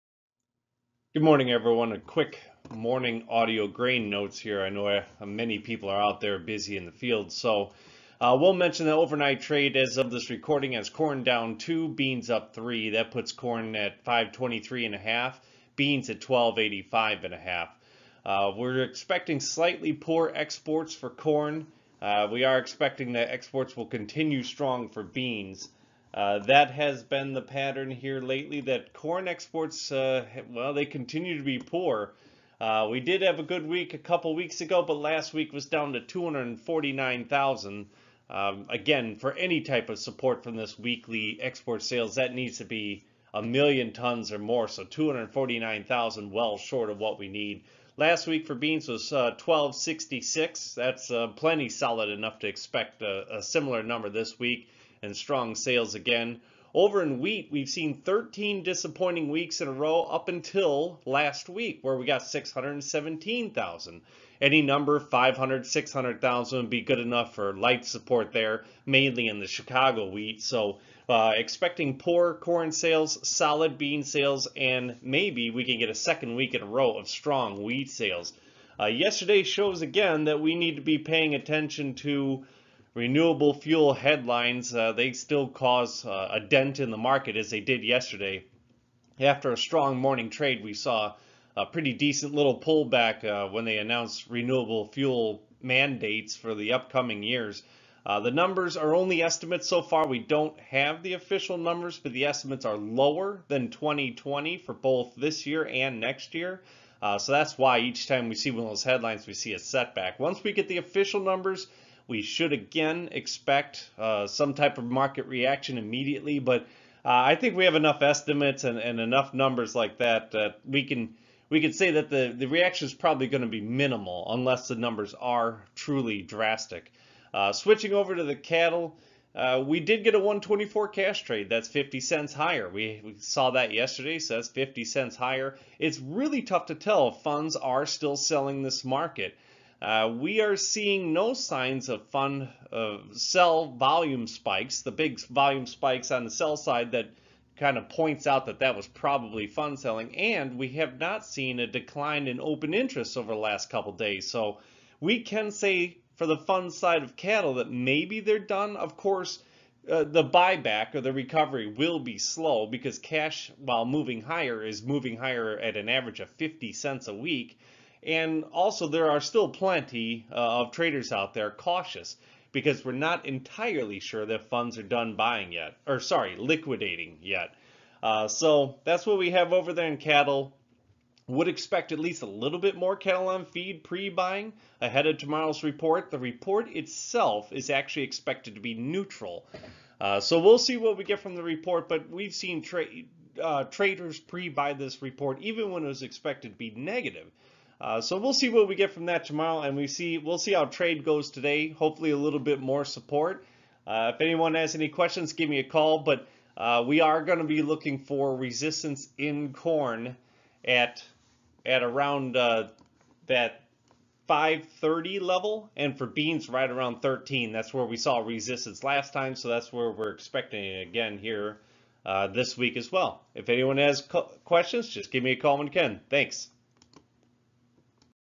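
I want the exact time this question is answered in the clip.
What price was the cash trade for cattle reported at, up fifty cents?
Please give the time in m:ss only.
2:10.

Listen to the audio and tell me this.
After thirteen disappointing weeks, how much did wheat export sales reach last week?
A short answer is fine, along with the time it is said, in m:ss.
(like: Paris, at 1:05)
617,000, at 1:02.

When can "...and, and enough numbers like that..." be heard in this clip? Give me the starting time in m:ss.
1:58.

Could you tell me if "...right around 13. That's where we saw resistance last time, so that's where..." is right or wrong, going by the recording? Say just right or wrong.
right.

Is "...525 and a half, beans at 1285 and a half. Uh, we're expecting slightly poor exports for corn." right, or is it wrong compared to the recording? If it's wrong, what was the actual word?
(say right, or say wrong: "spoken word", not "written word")
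wrong: "523", not "525".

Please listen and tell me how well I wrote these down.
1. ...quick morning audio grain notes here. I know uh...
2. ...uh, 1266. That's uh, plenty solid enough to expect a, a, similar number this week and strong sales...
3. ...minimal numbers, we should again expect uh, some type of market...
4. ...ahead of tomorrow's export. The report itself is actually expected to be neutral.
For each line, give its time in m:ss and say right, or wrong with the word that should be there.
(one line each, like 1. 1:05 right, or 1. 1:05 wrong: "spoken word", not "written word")
1. 0:01 right
2. 0:49 right
3. 1:50 wrong: "official", not "minimal"
4. 3:04 wrong: "report", not "export".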